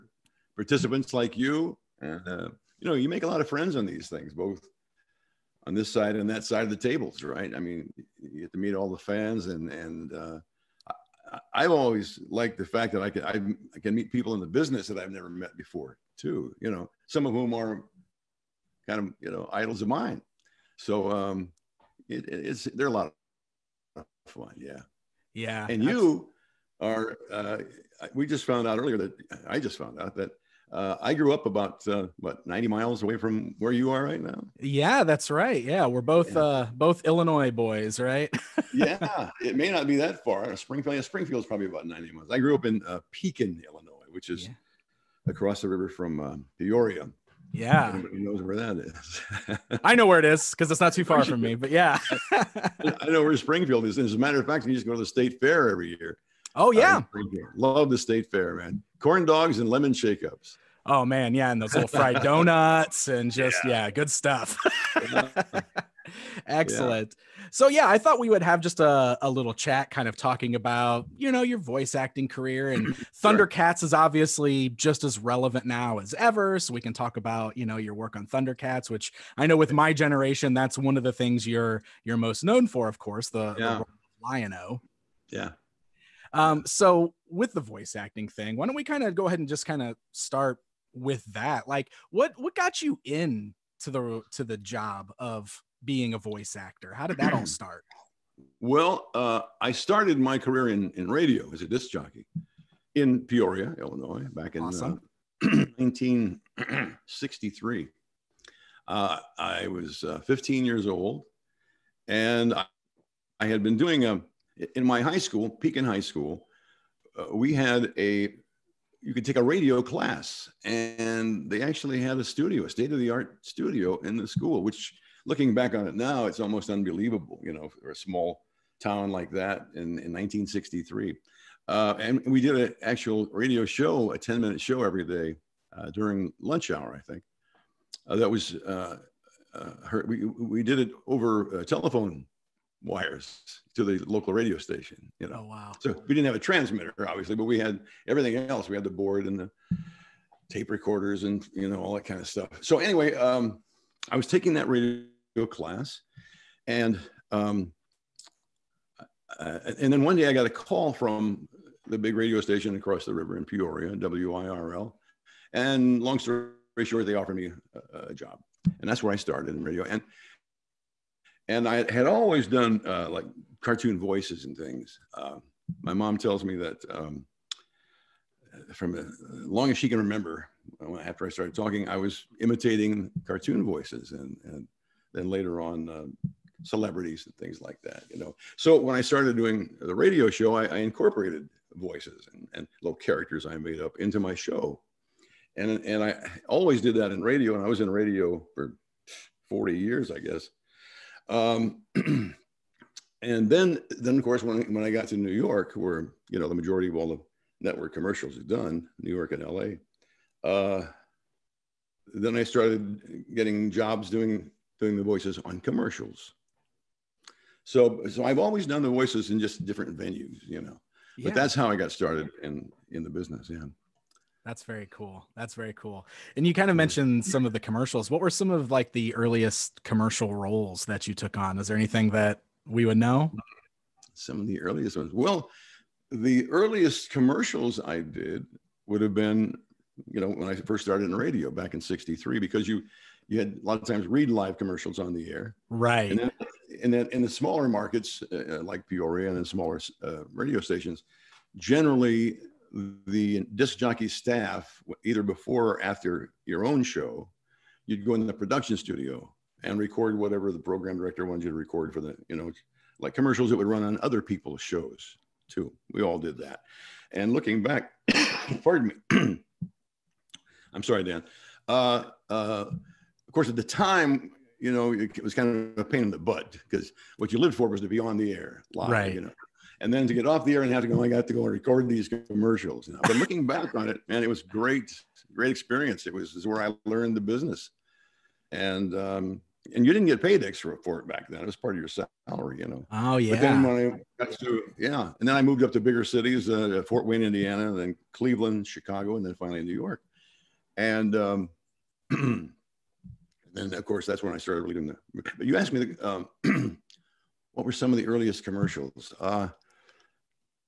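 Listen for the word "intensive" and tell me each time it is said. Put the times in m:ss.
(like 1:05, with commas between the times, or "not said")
not said.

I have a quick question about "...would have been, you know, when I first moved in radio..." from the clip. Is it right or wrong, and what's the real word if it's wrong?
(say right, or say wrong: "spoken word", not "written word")
wrong: "started", not "moved".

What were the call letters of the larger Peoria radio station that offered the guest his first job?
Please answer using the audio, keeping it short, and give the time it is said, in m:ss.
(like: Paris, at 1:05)
WIRL, at 2:43.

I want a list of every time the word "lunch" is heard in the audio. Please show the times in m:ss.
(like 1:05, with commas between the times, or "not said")
2:16.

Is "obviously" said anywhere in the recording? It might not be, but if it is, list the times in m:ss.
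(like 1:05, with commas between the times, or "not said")
1:13, 2:27.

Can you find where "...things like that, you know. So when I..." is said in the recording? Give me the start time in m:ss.
3:07.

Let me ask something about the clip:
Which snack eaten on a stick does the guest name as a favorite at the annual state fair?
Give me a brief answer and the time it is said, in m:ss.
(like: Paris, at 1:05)
Corn dogs, at 0:58.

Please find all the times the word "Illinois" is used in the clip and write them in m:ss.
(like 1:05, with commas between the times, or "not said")
0:37, 0:43, 1:43.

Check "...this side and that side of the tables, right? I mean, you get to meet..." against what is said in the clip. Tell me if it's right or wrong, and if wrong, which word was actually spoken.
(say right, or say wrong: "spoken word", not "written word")
right.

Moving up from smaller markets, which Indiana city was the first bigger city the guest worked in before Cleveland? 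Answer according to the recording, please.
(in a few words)
Fort Wayne.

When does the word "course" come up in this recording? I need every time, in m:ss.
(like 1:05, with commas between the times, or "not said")
1:22, 3:24, 4:33, 5:03.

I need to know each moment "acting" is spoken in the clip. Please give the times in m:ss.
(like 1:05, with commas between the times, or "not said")
1:11, 1:27.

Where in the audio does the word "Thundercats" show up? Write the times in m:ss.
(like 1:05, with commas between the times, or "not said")
1:13, 1:18.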